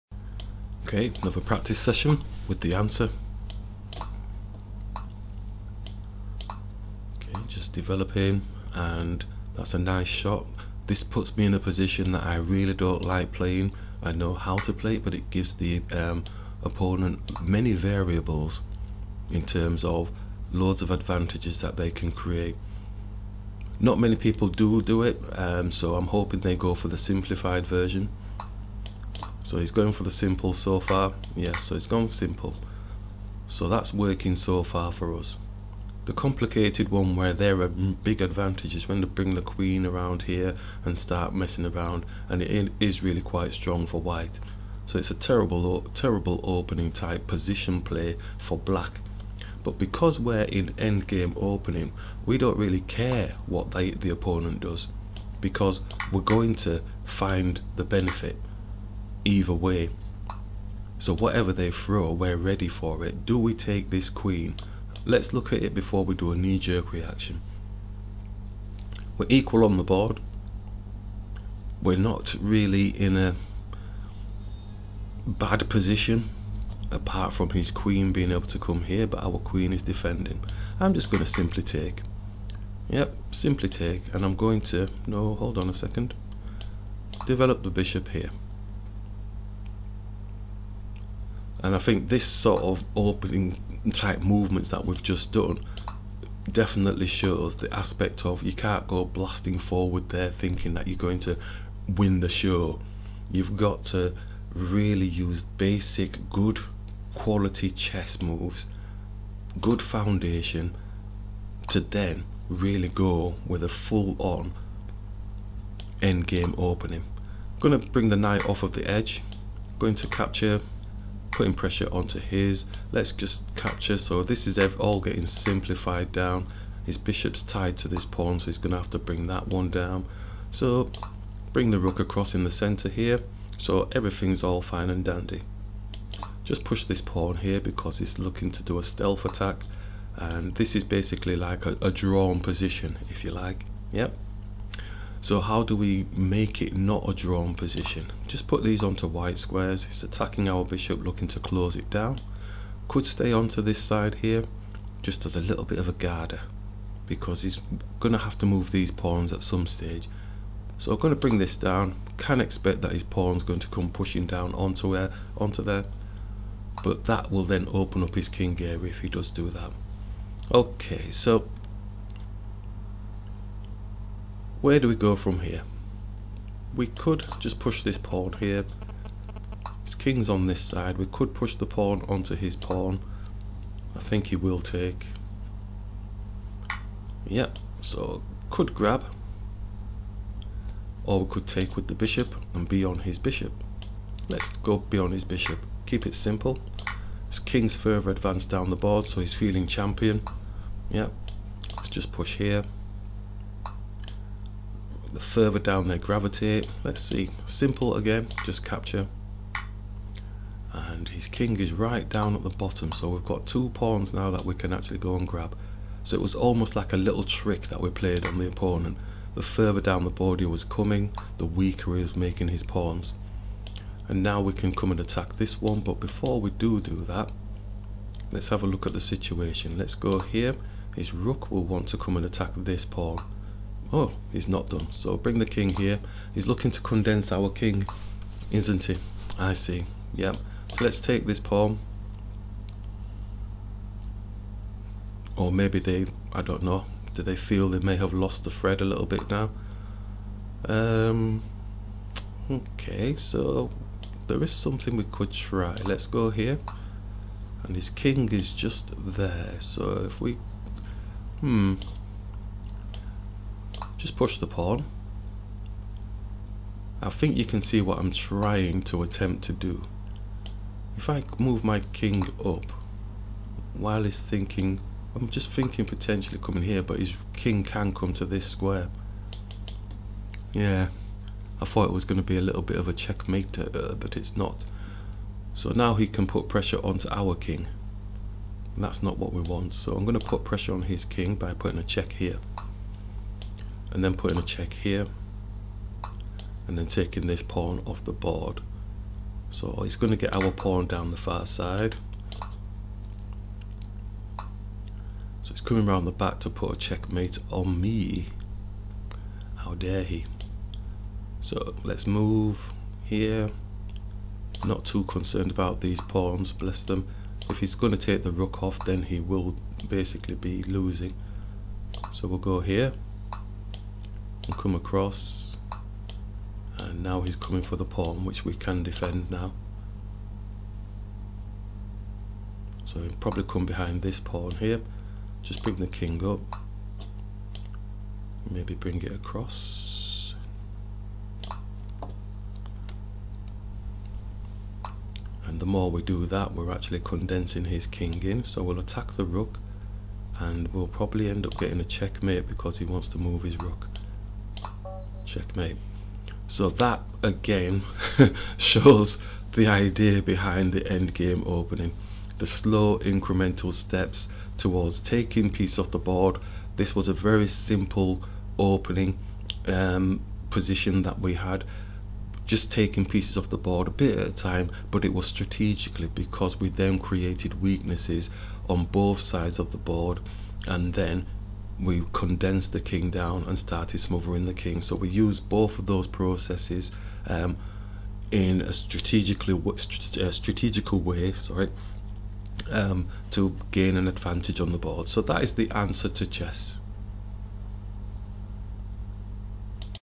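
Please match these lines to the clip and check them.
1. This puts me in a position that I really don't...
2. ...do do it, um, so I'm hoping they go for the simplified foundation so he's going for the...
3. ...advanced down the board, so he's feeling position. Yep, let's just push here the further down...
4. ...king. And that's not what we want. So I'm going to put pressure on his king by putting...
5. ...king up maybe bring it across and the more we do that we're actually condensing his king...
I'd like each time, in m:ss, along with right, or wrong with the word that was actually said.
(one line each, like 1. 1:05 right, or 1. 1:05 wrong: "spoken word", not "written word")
1. 0:10 right
2. 0:24 wrong: "version", not "foundation"
3. 3:18 wrong: "champion", not "position"
4. 4:47 right
5. 5:35 right.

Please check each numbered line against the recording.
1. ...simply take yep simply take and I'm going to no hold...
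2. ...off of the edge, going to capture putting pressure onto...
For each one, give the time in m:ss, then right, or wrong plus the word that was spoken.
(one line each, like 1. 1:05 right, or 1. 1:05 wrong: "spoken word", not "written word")
1. 1:21 right
2. 1:58 right.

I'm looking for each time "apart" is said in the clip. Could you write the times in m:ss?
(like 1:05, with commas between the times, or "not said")
1:16.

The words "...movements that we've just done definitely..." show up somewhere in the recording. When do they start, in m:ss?
1:34.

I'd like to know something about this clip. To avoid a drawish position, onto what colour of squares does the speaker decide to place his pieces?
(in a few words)
white squares.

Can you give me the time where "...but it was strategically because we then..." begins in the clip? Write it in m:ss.
6:14.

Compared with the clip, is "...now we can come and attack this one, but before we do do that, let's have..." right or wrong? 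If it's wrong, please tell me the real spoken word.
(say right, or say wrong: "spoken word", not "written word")
right.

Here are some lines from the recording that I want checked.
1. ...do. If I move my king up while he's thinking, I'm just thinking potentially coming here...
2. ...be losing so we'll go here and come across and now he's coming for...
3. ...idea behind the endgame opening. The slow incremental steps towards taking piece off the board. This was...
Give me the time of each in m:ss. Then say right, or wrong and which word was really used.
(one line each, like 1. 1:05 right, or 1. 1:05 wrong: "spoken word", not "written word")
1. 4:29 right
2. 5:20 right
3. 5:59 right.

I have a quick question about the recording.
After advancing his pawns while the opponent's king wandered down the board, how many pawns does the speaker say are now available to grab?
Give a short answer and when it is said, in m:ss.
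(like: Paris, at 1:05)
2, at 3:33.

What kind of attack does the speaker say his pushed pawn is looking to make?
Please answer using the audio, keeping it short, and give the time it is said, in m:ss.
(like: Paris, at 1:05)
stealth attack, at 2:18.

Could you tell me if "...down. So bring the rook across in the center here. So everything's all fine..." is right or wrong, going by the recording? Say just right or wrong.
right.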